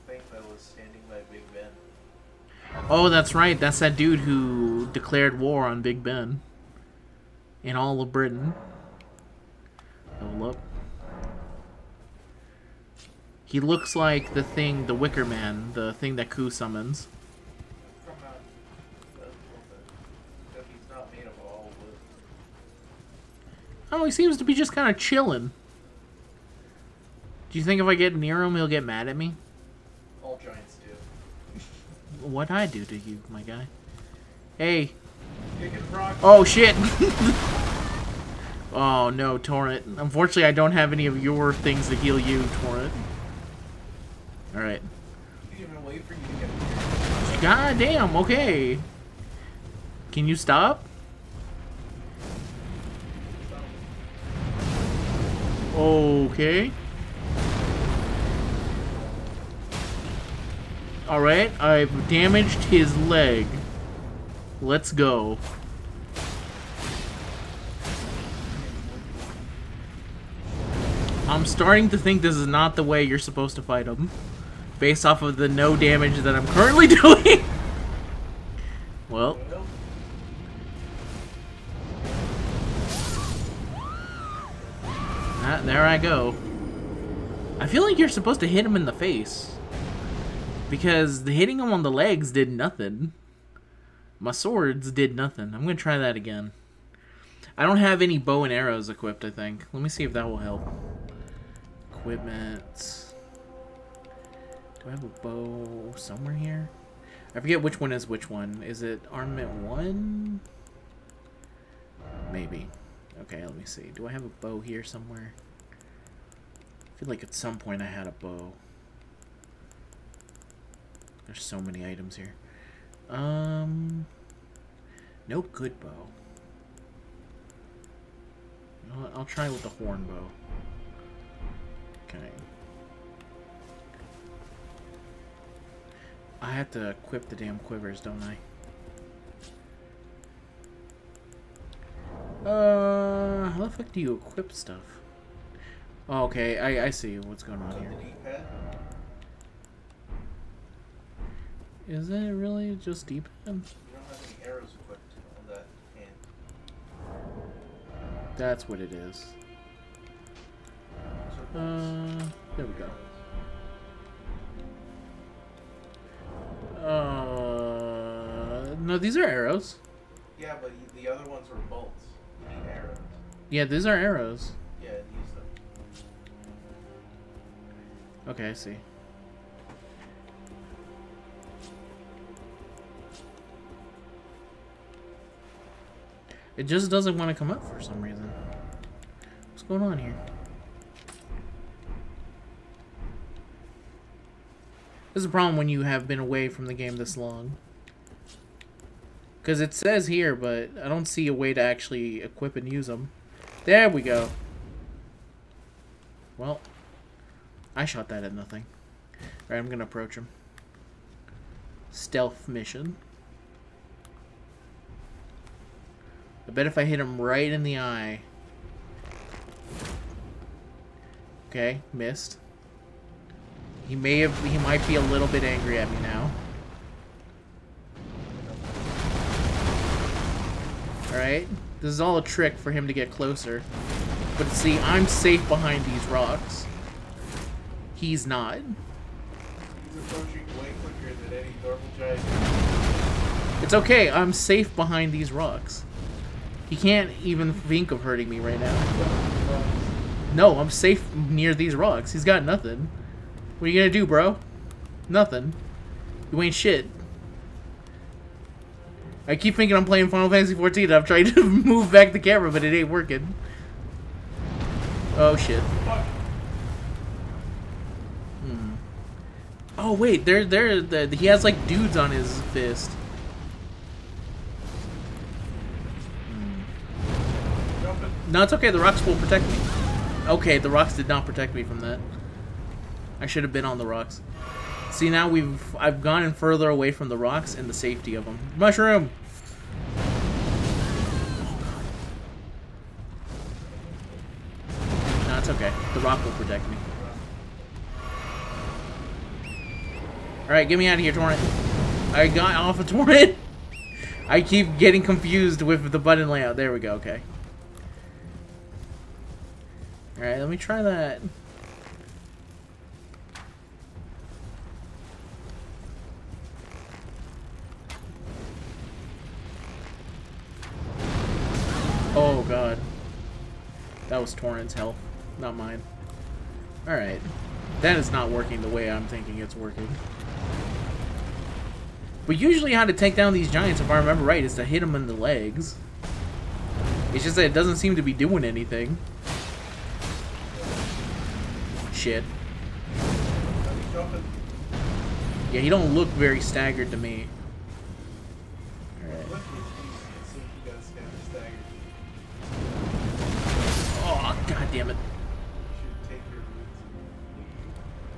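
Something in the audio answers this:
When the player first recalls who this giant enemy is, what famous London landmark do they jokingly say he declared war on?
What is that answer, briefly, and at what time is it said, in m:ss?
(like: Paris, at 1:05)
Big Ben, at 0:05.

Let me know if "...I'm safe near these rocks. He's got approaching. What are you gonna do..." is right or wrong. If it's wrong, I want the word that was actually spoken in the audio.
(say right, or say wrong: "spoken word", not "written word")
wrong: "nothing", not "approaching".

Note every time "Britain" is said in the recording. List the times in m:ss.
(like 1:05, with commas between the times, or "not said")
0:08.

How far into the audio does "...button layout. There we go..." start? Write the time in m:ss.
5:05.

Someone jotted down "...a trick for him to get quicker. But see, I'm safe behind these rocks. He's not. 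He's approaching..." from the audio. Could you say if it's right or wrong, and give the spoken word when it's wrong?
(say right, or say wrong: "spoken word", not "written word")
wrong: "closer", not "quicker".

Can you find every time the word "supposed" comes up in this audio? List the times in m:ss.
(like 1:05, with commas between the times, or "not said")
1:13, 1:28.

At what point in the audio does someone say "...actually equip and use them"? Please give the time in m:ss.
3:21.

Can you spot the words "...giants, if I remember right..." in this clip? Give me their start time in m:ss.
5:33.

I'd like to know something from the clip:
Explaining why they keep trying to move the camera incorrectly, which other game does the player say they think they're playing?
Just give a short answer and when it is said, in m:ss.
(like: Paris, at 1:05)
Final Fantasy 14, at 4:20.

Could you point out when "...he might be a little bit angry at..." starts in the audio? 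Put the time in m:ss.
3:44.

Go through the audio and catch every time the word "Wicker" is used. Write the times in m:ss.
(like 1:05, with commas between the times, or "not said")
0:14.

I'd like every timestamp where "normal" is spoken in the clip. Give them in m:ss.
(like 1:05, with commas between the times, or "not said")
4:01.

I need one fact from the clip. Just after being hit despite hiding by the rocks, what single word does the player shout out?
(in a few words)
Mushroom.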